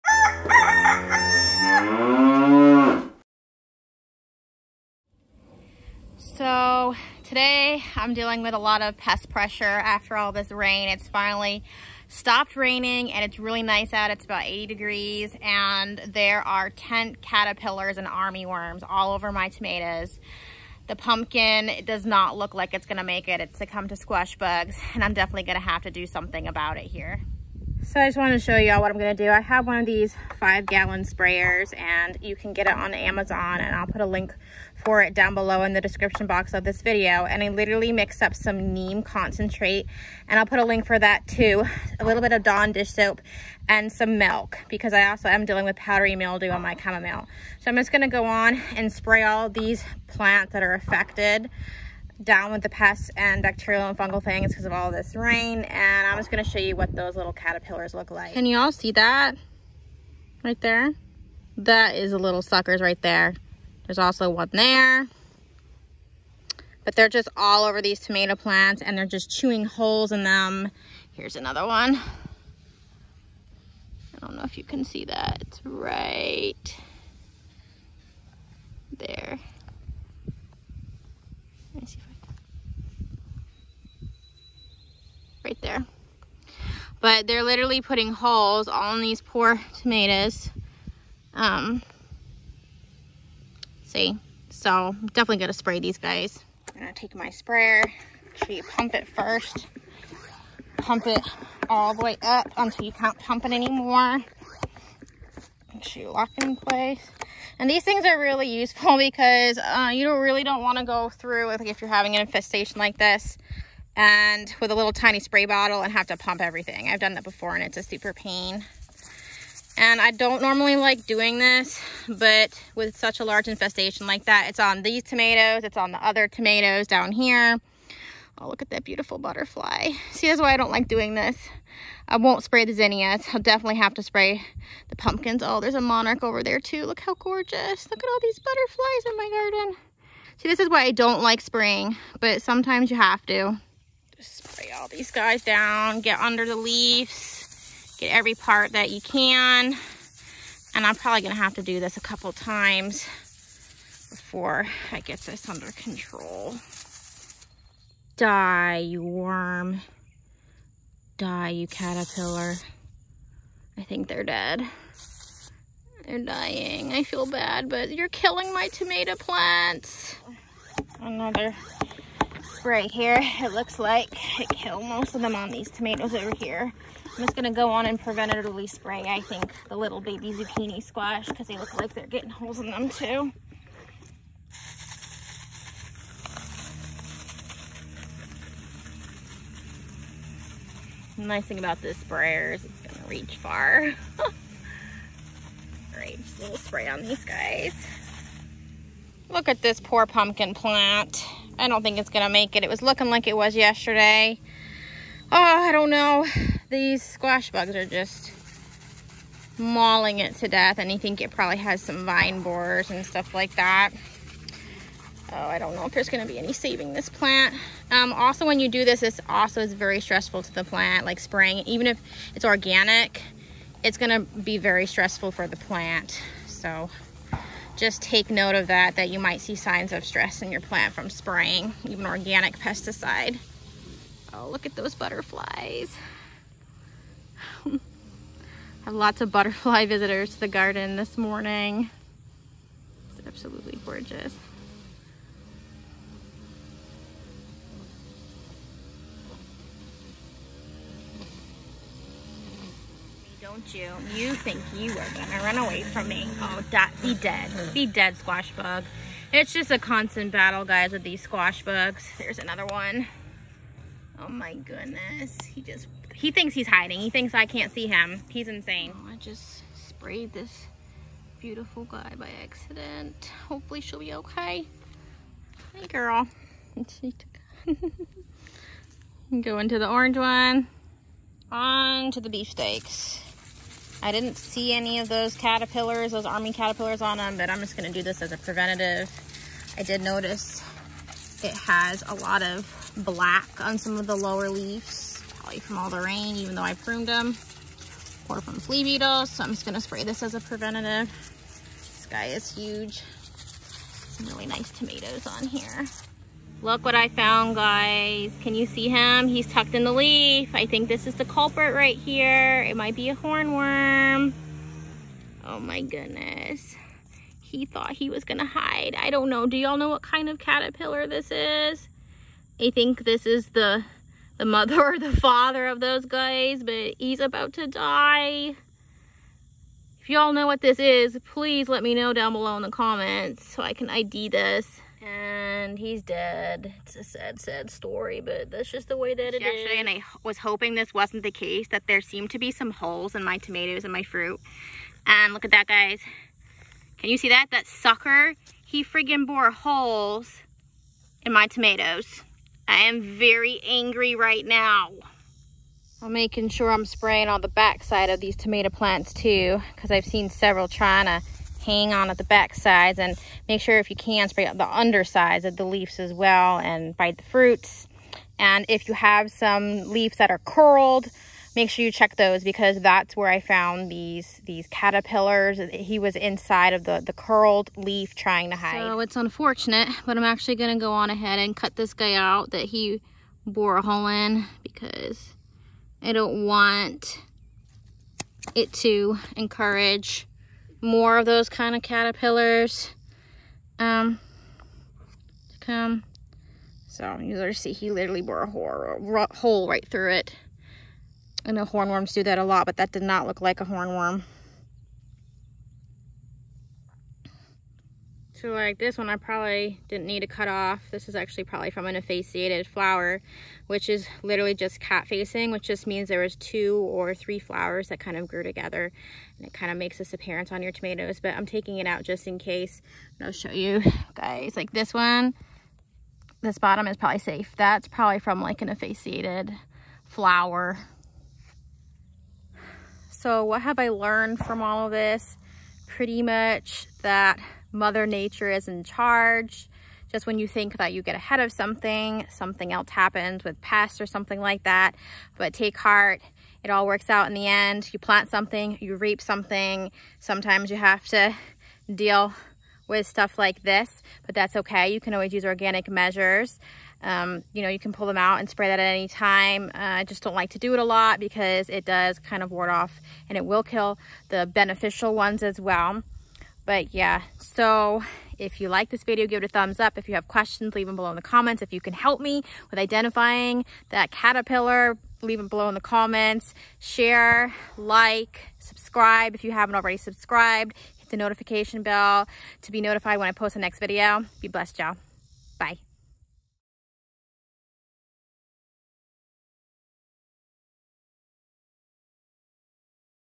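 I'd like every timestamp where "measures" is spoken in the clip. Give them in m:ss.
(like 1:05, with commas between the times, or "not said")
7:35.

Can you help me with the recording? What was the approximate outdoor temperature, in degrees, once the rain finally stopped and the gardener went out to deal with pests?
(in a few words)
80.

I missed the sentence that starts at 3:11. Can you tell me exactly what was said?
The nice thing about this sprayer is it's gonna reach far.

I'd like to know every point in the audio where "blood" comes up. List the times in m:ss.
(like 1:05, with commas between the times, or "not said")
not said.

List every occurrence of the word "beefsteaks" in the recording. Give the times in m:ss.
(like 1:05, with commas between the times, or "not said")
4:42.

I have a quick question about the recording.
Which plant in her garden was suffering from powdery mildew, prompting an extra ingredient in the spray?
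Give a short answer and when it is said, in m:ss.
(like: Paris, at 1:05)
chamomile, at 0:46.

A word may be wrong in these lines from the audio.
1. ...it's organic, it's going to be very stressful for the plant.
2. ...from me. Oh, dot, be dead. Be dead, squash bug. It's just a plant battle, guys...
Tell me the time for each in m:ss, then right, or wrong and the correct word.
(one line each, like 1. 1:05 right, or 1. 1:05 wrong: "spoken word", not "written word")
1. 3:42 right
2. 4:15 wrong: "constant", not "plant".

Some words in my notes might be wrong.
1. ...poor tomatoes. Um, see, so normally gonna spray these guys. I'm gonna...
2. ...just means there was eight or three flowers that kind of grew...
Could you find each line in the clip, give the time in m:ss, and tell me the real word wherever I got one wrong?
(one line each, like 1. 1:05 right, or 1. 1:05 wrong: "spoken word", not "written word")
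1. 1:29 wrong: "definitely", not "normally"
2. 6:55 wrong: "two", not "eight".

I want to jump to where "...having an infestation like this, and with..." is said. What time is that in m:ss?
1:51.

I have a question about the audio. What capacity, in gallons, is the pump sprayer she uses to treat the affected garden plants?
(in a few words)
5.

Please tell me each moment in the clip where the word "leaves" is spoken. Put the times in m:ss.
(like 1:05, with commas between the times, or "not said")
2:26, 4:54, 6:05, 6:09, 7:50, 7:55.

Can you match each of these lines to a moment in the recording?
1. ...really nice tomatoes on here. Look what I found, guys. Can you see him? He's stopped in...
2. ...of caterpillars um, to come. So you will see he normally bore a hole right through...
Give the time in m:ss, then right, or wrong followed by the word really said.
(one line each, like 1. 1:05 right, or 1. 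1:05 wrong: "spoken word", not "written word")
1. 5:04 wrong: "tucked", not "stopped"
2. 6:31 wrong: "literally", not "normally".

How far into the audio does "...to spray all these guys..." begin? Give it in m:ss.
2:23.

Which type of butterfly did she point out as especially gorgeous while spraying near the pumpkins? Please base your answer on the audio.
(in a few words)
monarch.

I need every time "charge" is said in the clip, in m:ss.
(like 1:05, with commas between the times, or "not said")
7:18.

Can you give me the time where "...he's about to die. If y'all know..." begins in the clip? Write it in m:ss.
5:26.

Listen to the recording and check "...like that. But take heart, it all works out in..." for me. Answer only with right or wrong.
right.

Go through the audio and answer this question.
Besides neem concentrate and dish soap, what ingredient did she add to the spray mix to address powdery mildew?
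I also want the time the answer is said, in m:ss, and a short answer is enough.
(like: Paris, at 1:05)
milk, at 0:43.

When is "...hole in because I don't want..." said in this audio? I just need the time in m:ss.
6:23.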